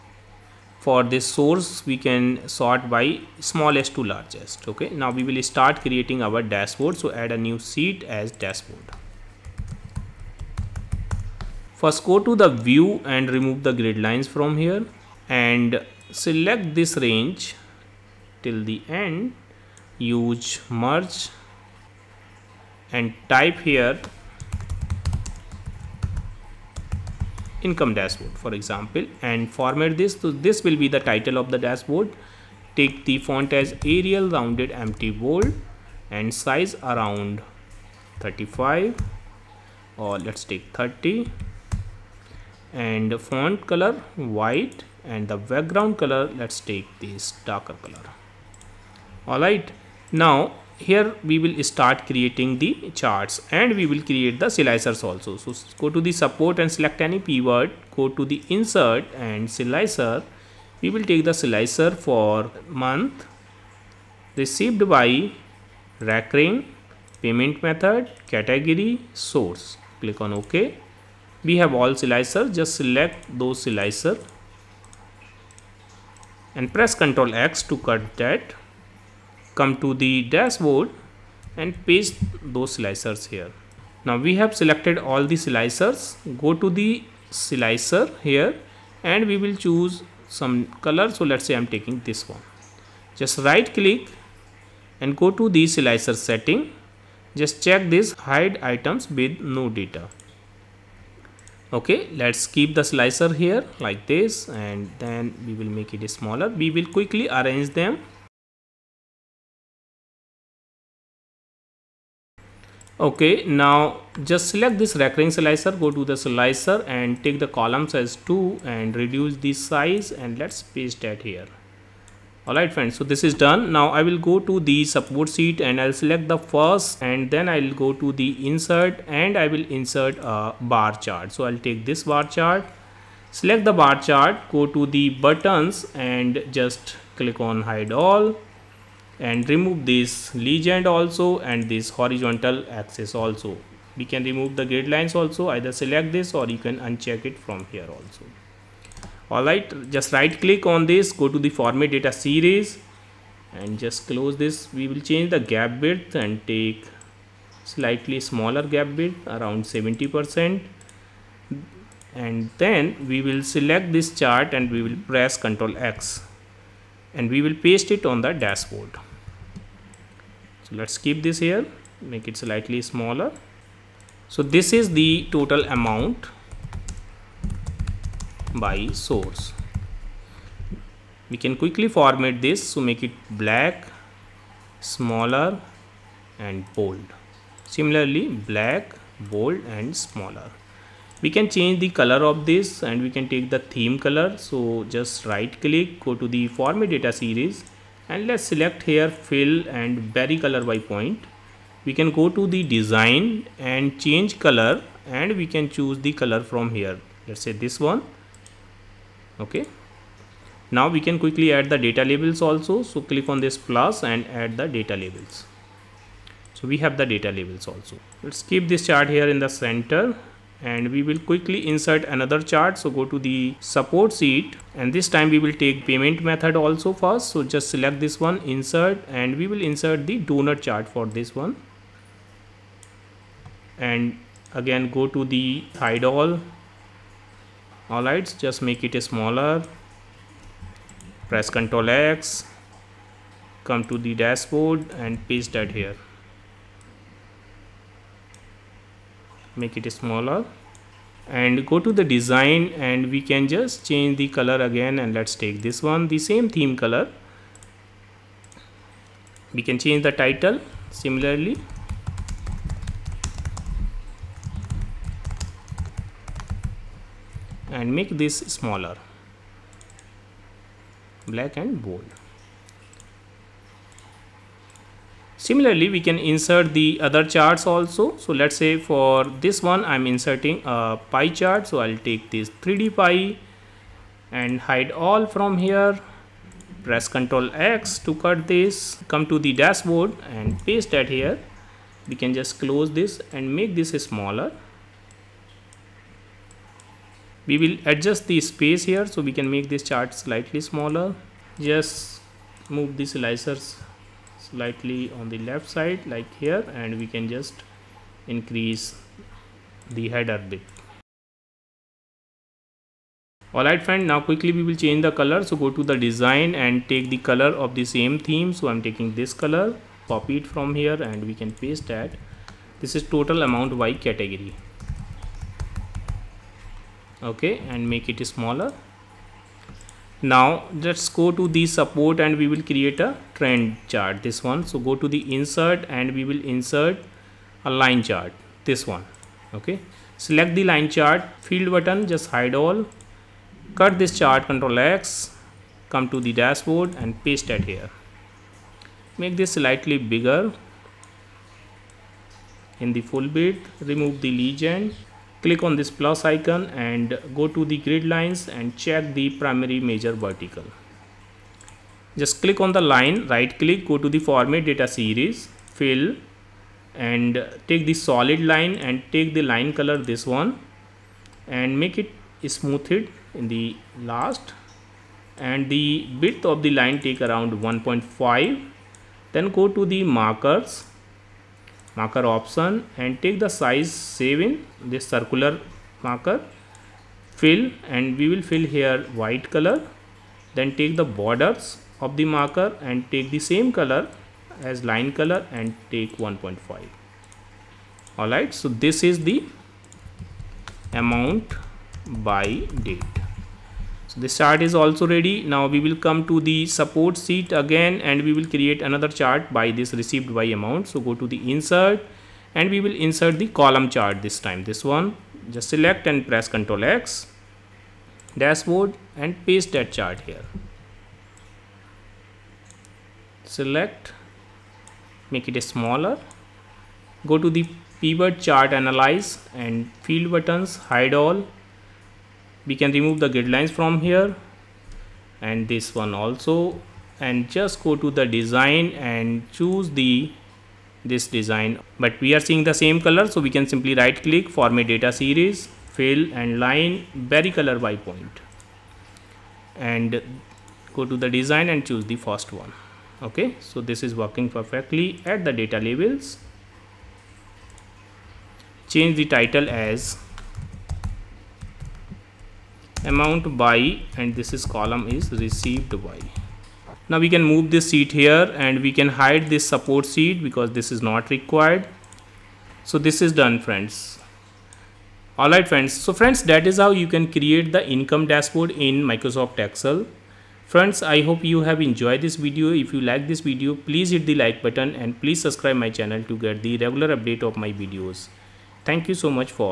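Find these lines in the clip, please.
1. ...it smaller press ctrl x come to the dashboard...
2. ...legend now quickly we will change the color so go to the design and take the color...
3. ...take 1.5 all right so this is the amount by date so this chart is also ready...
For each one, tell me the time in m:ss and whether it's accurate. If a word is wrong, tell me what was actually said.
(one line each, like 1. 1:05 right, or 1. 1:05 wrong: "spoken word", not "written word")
1. 3:58 right
2. 5:13 wrong: "friend", not "legend"
3. 6:35 right.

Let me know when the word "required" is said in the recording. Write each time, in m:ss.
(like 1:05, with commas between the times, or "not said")
7:51.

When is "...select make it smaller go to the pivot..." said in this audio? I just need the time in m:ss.
7:03.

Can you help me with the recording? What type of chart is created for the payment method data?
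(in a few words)
Doughnut chart.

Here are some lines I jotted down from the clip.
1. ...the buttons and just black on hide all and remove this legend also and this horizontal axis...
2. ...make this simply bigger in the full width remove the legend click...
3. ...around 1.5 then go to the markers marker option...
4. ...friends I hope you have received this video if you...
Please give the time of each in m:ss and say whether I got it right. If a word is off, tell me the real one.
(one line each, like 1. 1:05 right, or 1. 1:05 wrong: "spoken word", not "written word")
1. 2:14 wrong: "click", not "black"
2. 5:49 wrong: "slightly", not "simply"
3. 6:17 right
4. 8:00 wrong: "enjoyed", not "received".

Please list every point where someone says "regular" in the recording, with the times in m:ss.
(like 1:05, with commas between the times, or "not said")
8:06.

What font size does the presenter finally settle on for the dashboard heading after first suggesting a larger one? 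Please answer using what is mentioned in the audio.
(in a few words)
30.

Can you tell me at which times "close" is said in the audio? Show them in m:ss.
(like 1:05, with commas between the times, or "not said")
2:34, 4:52.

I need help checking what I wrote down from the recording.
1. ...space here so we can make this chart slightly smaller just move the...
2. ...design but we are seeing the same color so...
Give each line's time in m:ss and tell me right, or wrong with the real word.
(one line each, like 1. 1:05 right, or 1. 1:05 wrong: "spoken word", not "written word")
1. 4:58 right
2. 7:21 right.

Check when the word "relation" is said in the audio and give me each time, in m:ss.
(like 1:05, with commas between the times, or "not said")
not said.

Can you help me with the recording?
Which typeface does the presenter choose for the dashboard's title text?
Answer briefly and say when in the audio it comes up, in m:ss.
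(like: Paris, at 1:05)
Arial Rounded MT Bold, at 0:33.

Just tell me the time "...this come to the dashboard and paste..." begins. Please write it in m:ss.
4:48.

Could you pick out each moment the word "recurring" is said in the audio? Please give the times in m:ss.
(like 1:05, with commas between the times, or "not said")
1:06, 1:54.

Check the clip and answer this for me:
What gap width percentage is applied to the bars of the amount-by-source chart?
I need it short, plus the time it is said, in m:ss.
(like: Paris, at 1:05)
70 percent, at 2:39.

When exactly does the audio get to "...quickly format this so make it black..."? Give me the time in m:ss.
3:01.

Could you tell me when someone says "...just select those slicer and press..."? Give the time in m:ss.
1:12.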